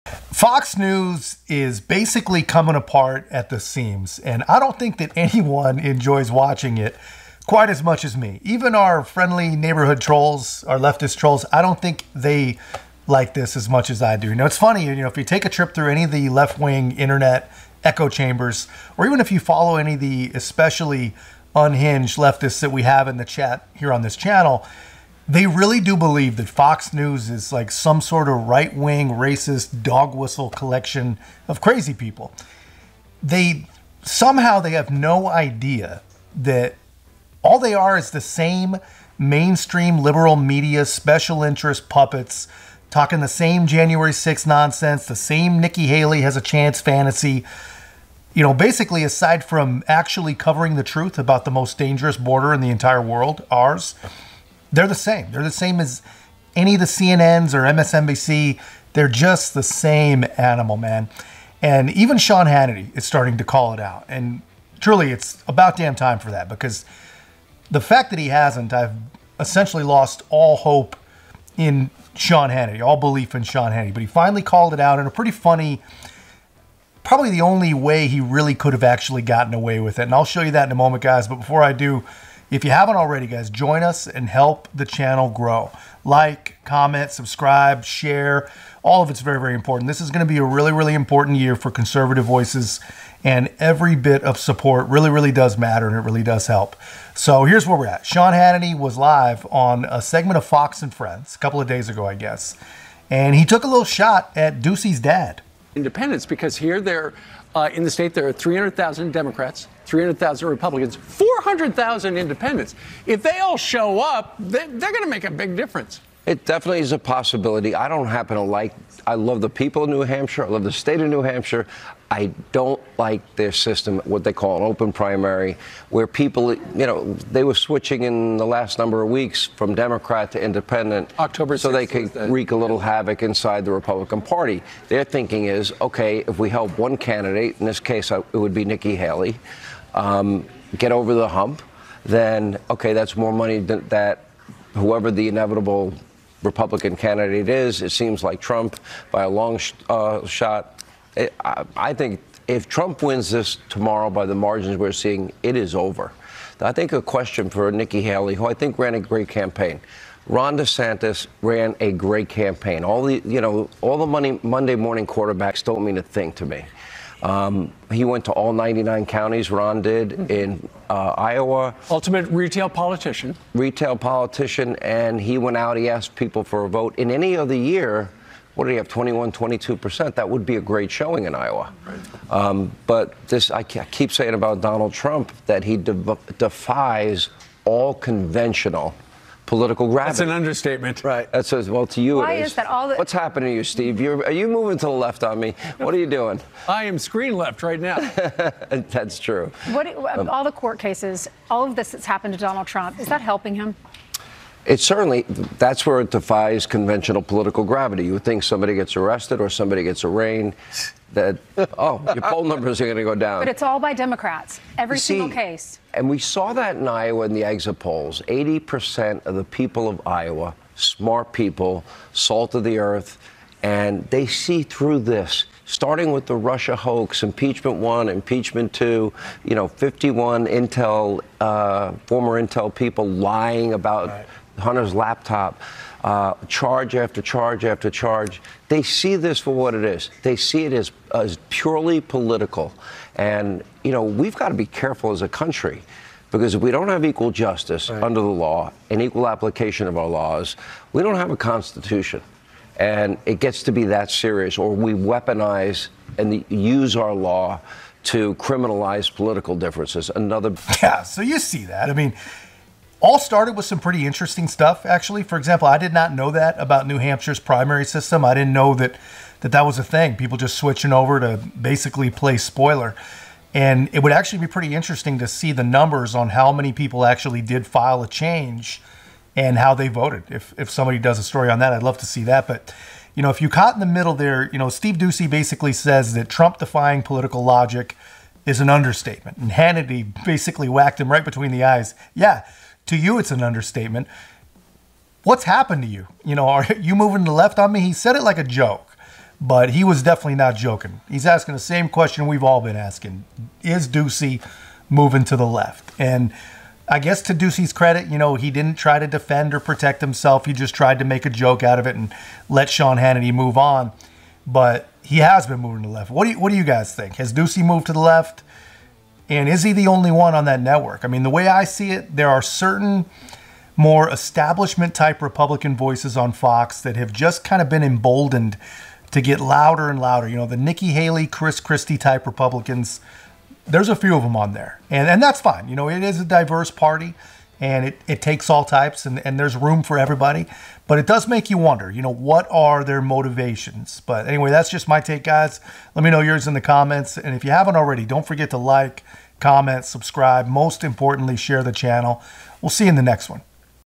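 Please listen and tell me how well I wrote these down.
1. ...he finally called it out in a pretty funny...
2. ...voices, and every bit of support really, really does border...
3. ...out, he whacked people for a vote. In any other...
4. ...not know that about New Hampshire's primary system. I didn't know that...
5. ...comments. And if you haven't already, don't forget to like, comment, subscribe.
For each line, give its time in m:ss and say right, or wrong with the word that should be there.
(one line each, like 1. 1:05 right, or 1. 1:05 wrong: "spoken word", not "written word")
1. 1:14 right
2. 1:32 wrong: "matter", not "border"
3. 2:55 wrong: "asked", not "whacked"
4. 4:25 right
5. 5:46 right.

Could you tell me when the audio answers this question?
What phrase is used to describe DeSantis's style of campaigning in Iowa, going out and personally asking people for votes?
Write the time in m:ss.
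2:51.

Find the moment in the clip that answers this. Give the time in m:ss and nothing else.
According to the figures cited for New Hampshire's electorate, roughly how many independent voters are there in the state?
1:51.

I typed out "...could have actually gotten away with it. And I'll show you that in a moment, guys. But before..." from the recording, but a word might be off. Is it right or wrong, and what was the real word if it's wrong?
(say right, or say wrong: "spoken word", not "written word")
right.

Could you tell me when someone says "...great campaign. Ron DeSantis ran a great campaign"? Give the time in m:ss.
2:38.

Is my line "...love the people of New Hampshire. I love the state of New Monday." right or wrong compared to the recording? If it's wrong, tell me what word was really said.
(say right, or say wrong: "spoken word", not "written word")
wrong: "Hampshire", not "Monday".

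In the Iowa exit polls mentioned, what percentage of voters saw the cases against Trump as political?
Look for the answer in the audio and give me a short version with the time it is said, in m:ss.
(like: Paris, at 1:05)
80%, at 3:38.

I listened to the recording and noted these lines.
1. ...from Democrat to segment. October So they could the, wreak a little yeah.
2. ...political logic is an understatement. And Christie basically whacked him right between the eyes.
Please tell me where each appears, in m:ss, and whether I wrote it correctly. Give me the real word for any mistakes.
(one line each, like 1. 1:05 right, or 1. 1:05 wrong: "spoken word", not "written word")
1. 2:09 wrong: "independent", not "segment"
2. 4:47 wrong: "Hannity", not "Christie".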